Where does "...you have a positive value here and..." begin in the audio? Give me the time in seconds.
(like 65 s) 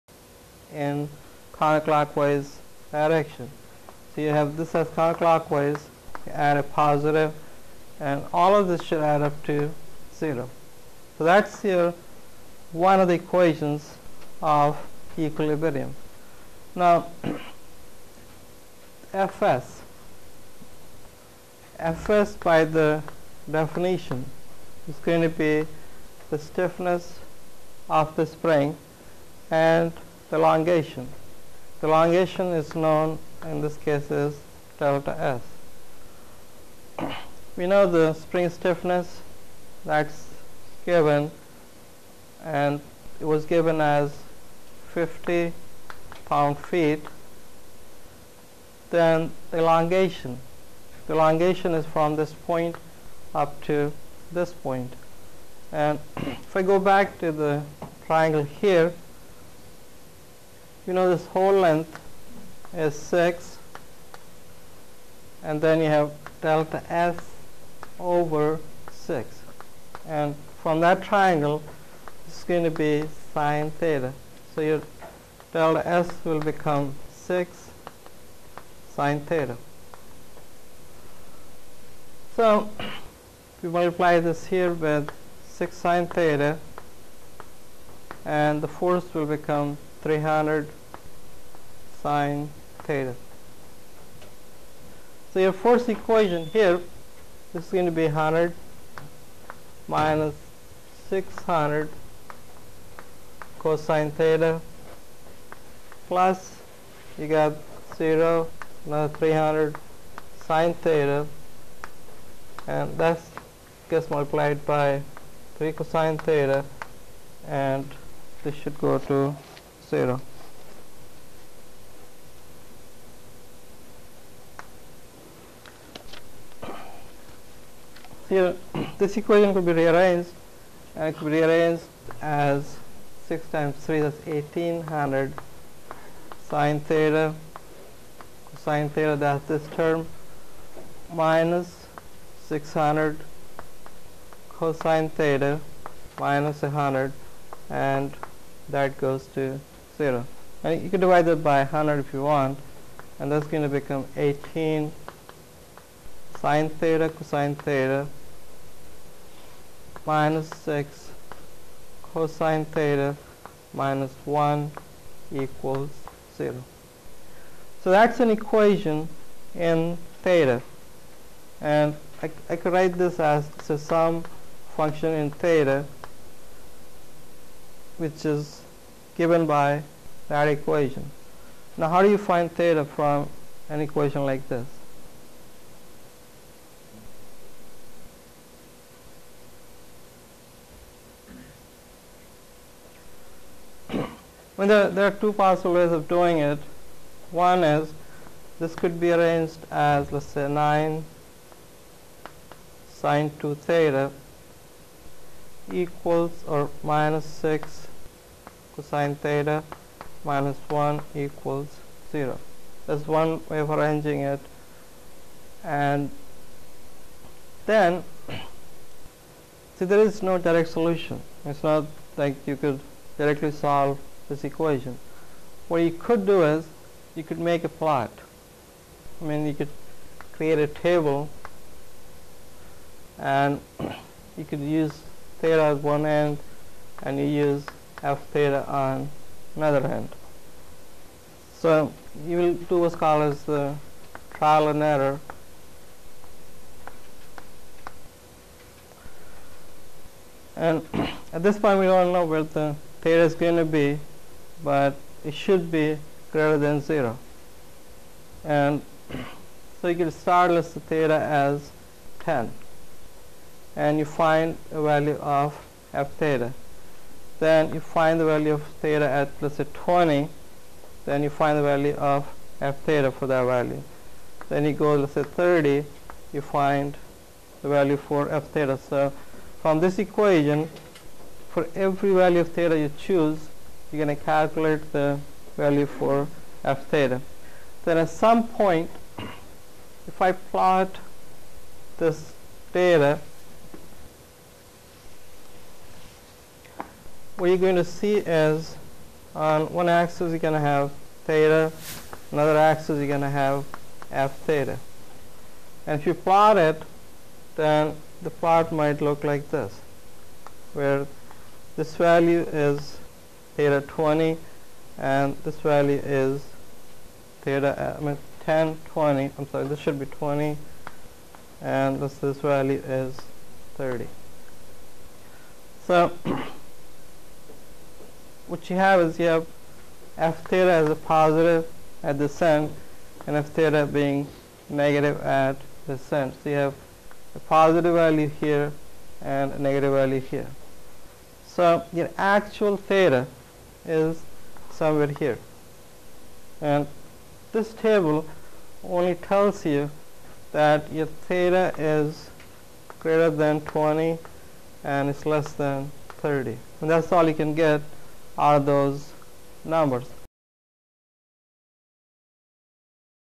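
336 s.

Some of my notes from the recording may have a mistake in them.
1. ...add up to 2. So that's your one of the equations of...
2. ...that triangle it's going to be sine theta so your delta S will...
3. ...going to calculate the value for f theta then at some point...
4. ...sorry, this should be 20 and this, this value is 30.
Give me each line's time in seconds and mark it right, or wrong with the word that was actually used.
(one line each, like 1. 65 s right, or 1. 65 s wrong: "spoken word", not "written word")
1. 9 s wrong: "0", not "2"
2. 70 s right
3. 284 s right
4. 319 s right.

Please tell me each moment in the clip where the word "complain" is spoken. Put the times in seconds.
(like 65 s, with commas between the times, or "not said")
not said.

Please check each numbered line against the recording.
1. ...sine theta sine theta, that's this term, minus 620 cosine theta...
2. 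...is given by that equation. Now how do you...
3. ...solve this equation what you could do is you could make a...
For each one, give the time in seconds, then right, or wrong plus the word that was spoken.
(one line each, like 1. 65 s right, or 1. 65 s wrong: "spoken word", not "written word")
1. 136 s wrong: "600", not "620"
2. 178 s right
3. 223 s right.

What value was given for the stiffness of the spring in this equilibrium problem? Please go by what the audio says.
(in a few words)
50 pound feet.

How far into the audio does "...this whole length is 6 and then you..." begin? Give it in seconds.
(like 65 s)
61 s.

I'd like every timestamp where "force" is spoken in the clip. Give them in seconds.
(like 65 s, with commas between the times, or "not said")
88 s, 95 s.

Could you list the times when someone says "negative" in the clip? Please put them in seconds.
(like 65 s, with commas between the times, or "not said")
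334 s, 339 s.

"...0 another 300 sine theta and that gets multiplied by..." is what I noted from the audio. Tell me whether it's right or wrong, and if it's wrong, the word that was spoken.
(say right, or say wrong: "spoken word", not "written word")
right.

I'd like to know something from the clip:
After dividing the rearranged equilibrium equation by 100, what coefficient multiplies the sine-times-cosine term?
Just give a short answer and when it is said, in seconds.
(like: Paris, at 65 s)
18, at 154 s.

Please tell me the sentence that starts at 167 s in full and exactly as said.
So that's an equation in theta.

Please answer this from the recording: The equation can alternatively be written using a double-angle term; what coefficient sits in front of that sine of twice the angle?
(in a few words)
9.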